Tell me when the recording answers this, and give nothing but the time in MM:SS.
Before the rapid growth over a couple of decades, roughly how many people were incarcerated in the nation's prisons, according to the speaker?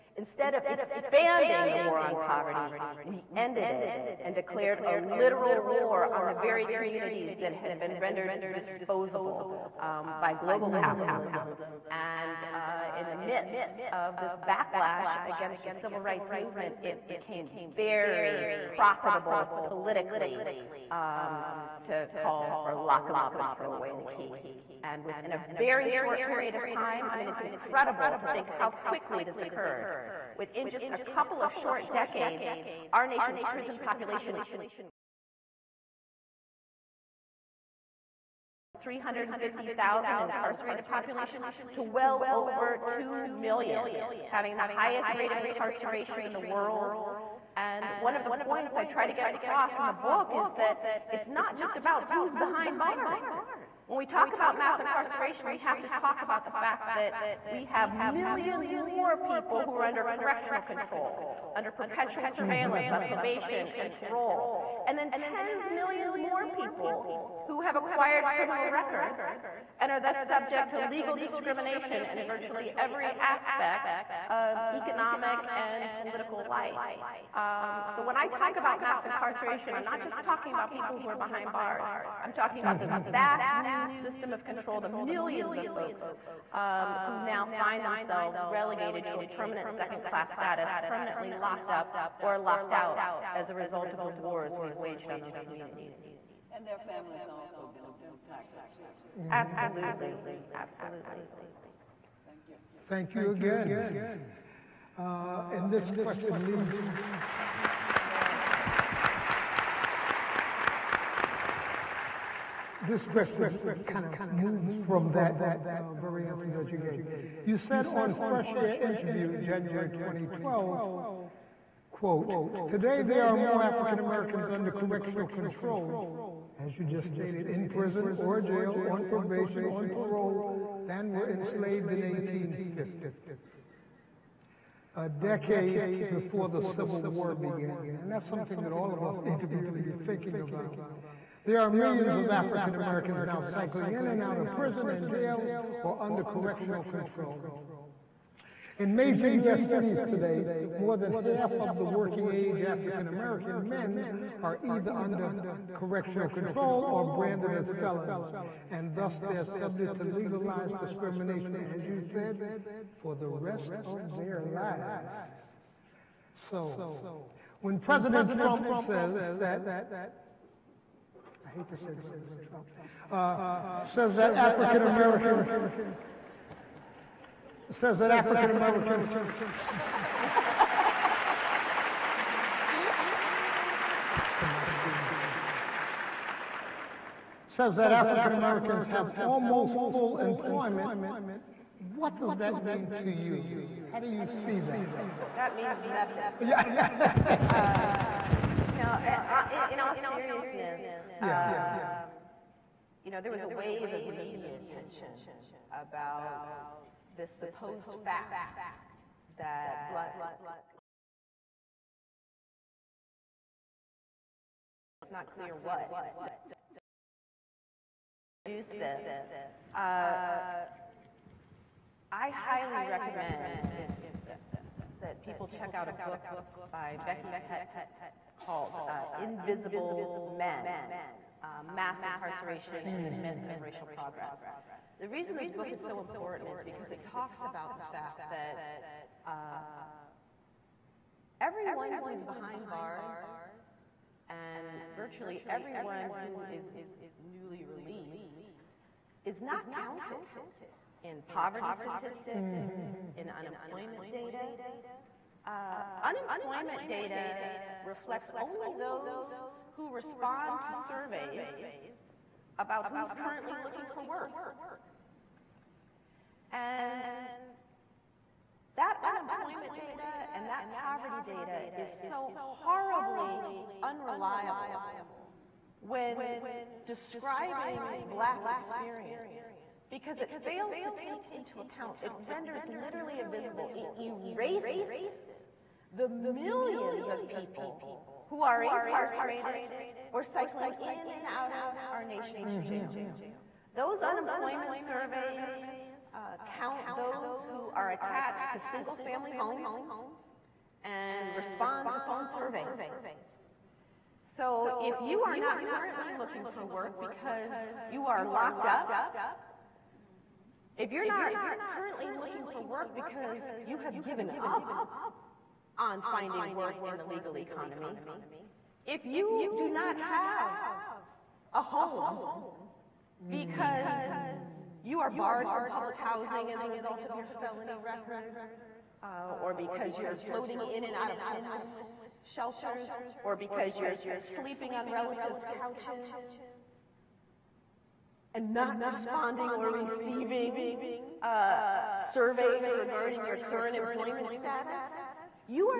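00:38.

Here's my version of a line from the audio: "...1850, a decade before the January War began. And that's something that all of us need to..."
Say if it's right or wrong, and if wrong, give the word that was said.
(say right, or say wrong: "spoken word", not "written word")
wrong: "Civil", not "January".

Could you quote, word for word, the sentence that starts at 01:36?
And their families also been impacted too.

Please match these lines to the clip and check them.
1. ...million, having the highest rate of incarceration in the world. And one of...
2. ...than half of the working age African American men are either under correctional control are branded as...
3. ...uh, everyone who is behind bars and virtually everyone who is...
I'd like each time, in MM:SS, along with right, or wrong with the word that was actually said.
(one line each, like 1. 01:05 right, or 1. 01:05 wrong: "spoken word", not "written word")
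1. 00:43 right
2. 02:30 right
3. 03:59 right.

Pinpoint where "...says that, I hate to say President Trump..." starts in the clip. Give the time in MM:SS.
02:48.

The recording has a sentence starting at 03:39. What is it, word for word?
Uh, I highly recommend if that people check out a book by Becky Pettit called uh, Invisible Men, uh, Mass Incarceration mm.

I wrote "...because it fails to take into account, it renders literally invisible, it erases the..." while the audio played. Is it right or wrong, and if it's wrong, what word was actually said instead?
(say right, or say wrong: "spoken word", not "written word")
right.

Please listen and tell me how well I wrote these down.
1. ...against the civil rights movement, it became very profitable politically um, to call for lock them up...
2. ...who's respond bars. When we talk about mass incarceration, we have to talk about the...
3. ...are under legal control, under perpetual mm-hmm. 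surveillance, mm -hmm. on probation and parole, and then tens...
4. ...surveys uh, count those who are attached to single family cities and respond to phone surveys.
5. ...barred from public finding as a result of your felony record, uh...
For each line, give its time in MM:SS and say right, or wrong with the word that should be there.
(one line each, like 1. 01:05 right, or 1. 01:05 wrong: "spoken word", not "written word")
1. 00:15 right
2. 00:52 wrong: "behind", not "respond"
3. 00:59 wrong: "correctional", not "legal"
4. 04:54 wrong: "homes", not "cities"
5. 05:25 wrong: "housing", not "finding".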